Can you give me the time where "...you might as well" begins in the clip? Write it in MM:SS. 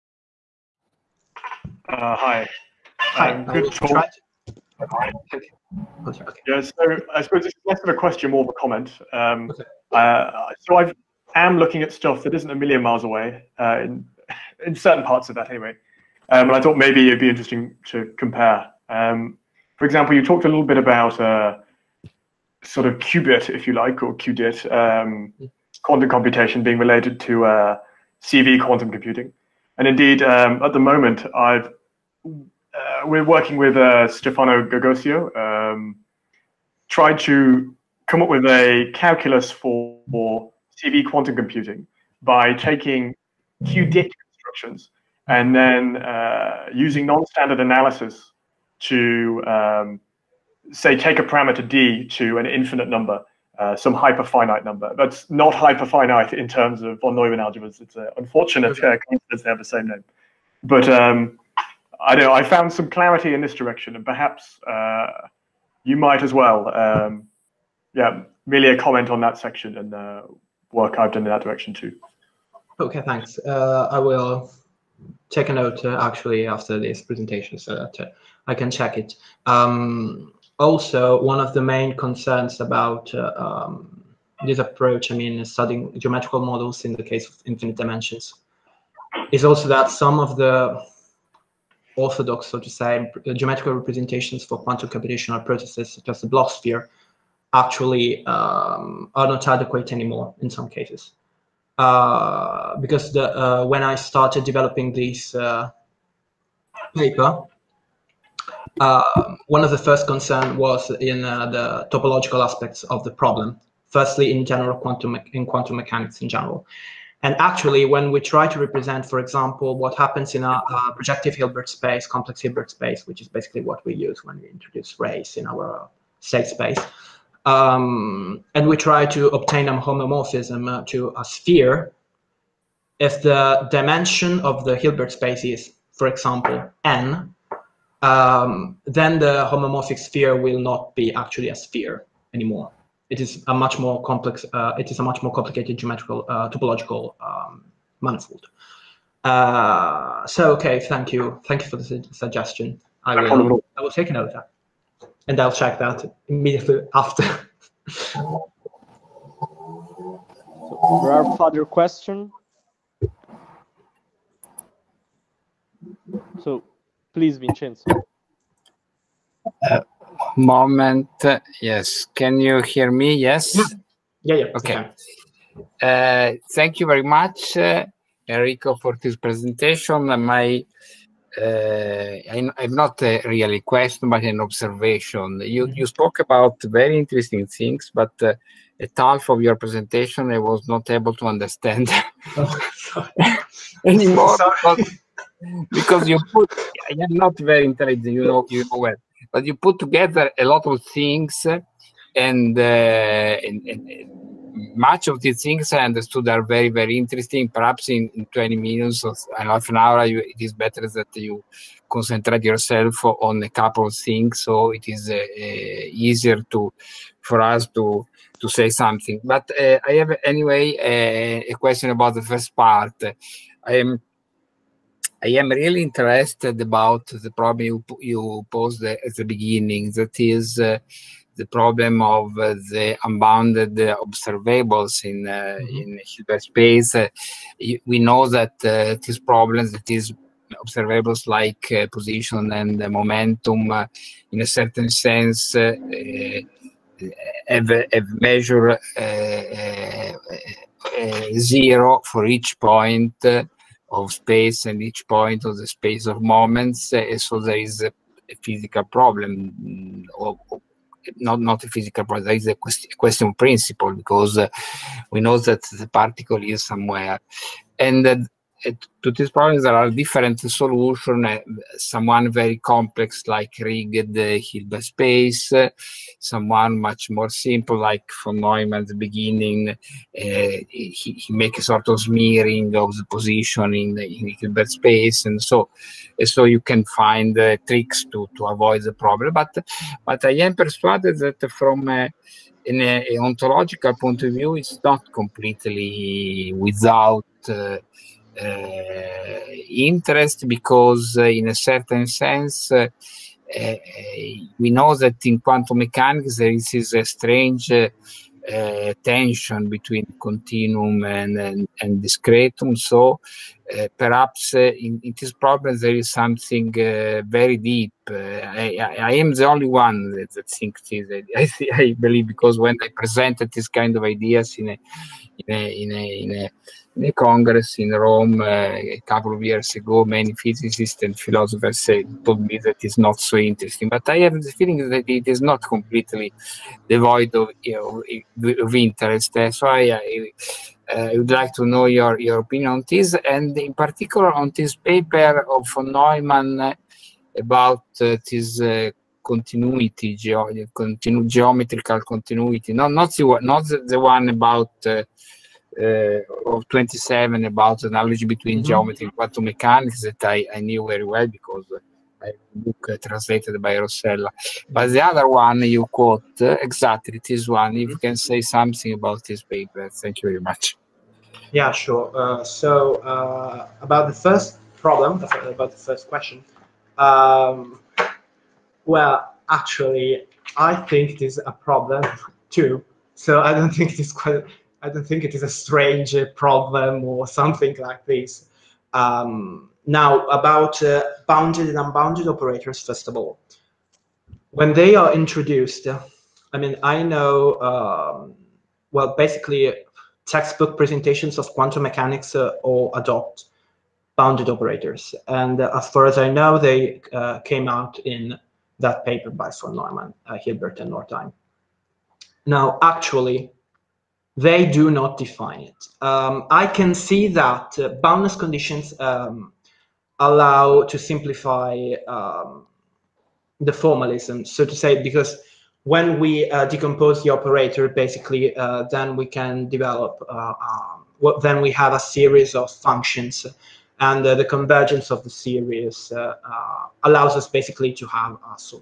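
01:05.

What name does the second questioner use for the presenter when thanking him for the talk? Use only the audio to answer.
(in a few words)
Enrico.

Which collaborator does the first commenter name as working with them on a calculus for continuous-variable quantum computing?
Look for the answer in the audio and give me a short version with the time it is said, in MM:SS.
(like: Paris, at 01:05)
Stefano Gogioso, at 00:34.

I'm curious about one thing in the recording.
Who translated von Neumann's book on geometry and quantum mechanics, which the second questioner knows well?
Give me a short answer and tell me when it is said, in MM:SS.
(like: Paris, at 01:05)
Rossella, at 06:03.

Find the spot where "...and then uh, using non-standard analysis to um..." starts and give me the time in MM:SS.
00:45.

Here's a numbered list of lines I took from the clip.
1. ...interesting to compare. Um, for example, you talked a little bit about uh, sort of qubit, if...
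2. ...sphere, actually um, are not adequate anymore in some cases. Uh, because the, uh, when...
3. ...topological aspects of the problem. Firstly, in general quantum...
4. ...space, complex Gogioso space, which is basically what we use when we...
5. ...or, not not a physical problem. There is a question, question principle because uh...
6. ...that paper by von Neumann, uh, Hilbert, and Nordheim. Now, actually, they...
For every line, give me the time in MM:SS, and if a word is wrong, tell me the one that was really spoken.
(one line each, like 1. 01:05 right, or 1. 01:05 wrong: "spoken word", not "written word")
1. 00:17 right
2. 01:36 right
3. 01:51 right
4. 02:01 wrong: "Hilbert", not "Gogioso"
5. 04:20 right
6. 06:48 right.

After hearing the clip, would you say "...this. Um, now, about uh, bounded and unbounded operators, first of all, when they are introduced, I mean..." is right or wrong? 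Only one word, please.
right.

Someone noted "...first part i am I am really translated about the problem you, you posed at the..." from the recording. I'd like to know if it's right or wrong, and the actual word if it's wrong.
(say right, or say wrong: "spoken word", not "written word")
wrong: "interested", not "translated".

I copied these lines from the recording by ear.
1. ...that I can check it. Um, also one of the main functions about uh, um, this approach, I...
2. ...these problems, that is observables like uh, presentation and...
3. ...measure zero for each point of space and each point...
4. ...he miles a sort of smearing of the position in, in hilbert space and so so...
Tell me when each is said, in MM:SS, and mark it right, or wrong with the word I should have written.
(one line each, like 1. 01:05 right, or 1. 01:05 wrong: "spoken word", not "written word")
1. 01:17 wrong: "concerns", not "functions"
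2. 03:59 wrong: "position", not "presentation"
3. 04:08 right
4. 04:40 wrong: "makes", not "miles".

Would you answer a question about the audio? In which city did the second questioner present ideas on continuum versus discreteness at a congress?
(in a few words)
Rome.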